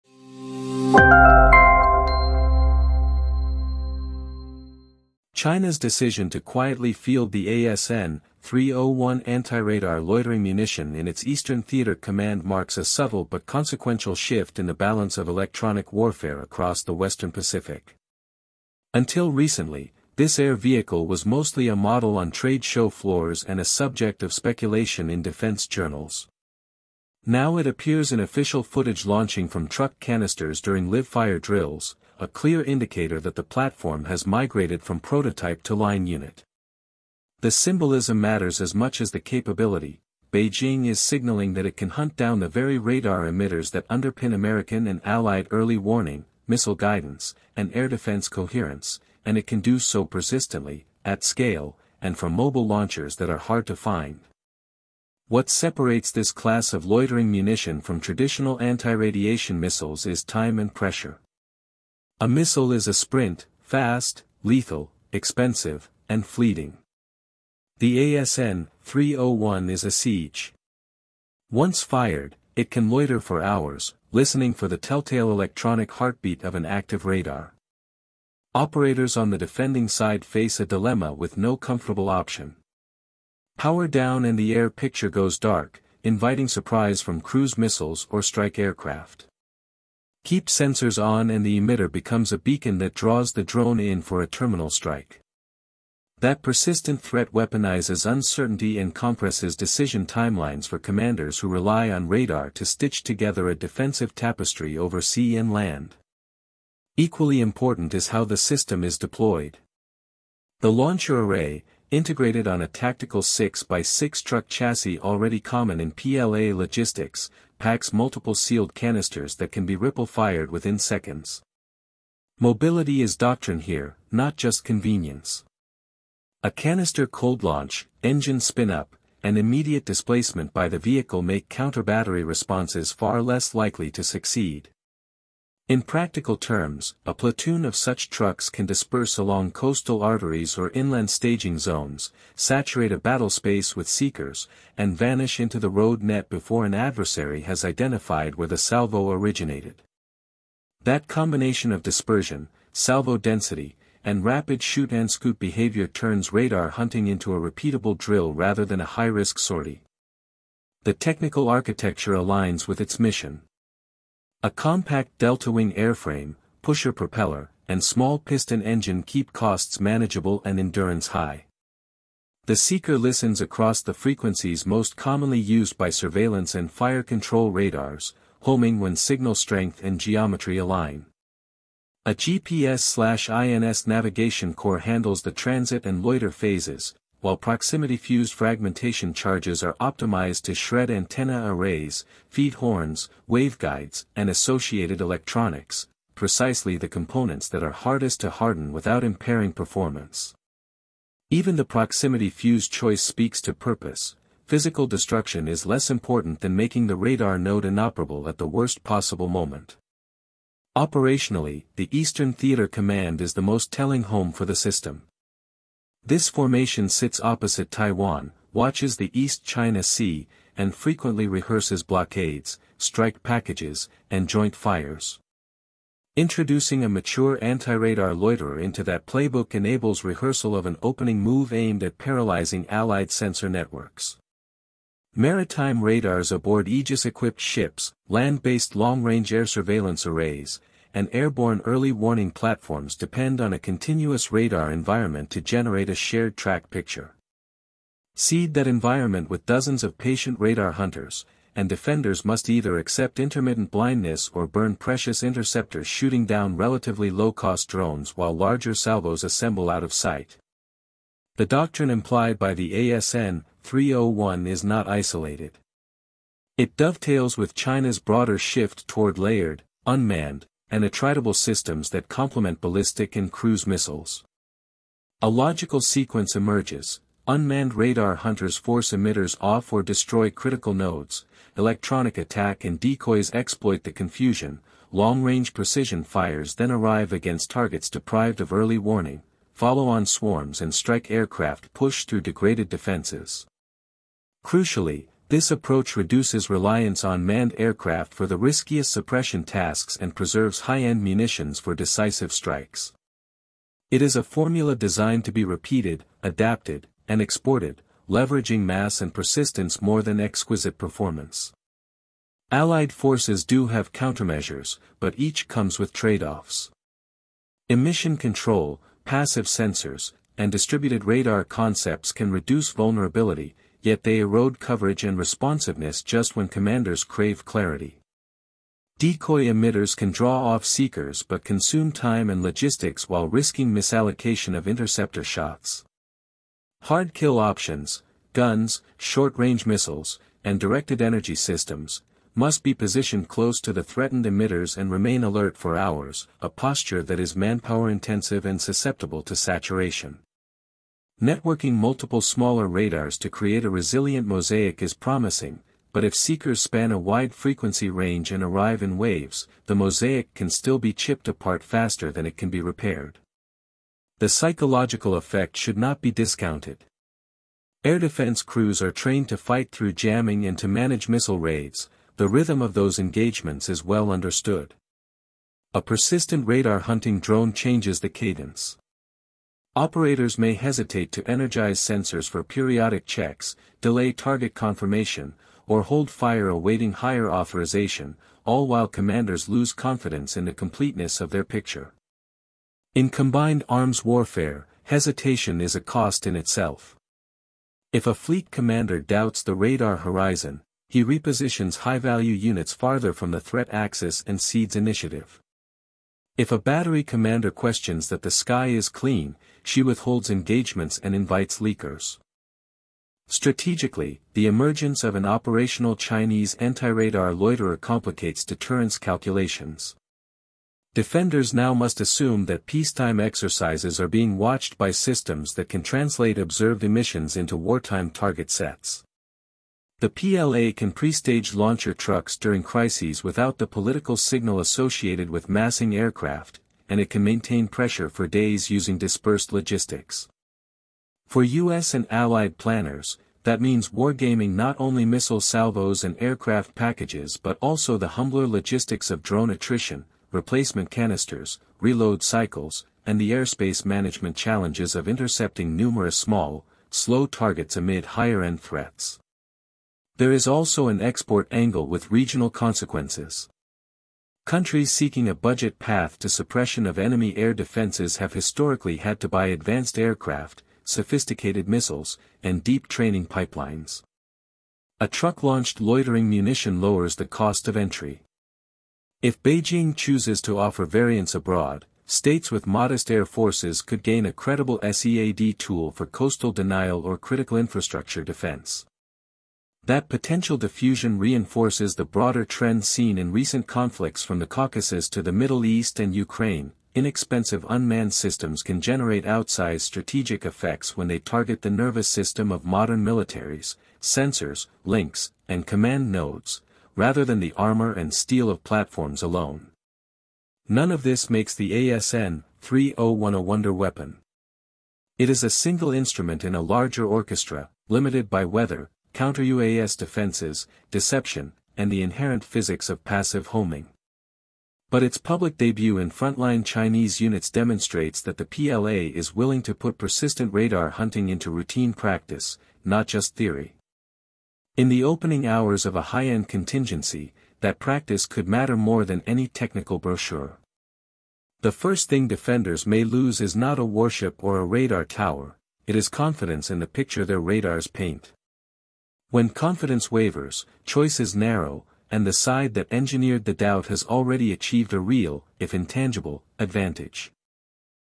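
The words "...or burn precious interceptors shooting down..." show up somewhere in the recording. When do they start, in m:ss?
4:14.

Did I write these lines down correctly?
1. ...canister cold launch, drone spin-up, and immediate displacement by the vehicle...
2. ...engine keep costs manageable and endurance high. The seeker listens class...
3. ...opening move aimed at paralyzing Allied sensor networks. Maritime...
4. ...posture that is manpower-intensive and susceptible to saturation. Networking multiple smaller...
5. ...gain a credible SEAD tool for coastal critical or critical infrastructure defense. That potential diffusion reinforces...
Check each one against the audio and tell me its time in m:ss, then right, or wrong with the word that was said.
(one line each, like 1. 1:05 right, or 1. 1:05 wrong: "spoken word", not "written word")
1. 2:06 wrong: "engine", not "drone"
2. 2:48 wrong: "across", not "class"
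3. 3:50 right
4. 5:46 right
5. 8:04 wrong: "denial", not "critical".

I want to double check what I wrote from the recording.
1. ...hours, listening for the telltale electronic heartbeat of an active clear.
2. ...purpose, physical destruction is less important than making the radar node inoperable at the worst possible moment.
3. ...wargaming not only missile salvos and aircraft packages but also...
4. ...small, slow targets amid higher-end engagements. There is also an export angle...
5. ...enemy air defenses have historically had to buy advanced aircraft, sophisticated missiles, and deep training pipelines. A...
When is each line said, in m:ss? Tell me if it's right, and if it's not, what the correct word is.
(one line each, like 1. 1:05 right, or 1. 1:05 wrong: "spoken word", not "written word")
1. 1:13 wrong: "radar", not "clear"
2. 3:23 right
3. 7:23 right
4. 7:36 wrong: "threats", not "engagements"
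5. 7:46 right.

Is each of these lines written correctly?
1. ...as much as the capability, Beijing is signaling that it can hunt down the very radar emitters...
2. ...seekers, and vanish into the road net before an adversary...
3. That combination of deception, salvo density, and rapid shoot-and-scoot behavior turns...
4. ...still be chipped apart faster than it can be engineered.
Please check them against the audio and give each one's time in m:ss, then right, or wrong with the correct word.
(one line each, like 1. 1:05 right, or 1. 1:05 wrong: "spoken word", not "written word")
1. 0:38 right
2. 2:23 right
3. 2:30 wrong: "dispersion", not "deception"
4. 6:00 wrong: "repaired", not "engineered".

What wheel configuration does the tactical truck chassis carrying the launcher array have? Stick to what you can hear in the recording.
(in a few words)
6x6.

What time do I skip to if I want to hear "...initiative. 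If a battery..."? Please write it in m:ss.
6:44.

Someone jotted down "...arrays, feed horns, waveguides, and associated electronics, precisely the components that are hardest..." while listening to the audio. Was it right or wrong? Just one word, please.
right.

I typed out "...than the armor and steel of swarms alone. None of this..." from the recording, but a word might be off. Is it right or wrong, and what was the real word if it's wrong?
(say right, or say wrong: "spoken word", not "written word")
wrong: "platforms", not "swarms".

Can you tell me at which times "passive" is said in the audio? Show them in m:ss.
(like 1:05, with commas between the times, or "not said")
5:19, 8:43.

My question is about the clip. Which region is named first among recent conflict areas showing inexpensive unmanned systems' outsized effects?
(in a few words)
the Caucasus.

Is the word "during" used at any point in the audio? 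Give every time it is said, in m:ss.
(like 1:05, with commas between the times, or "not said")
0:30, 7:12.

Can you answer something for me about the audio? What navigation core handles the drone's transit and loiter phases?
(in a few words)
GPS-INS.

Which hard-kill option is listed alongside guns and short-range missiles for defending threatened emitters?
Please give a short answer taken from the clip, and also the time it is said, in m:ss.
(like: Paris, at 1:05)
directed energy systems, at 5:40.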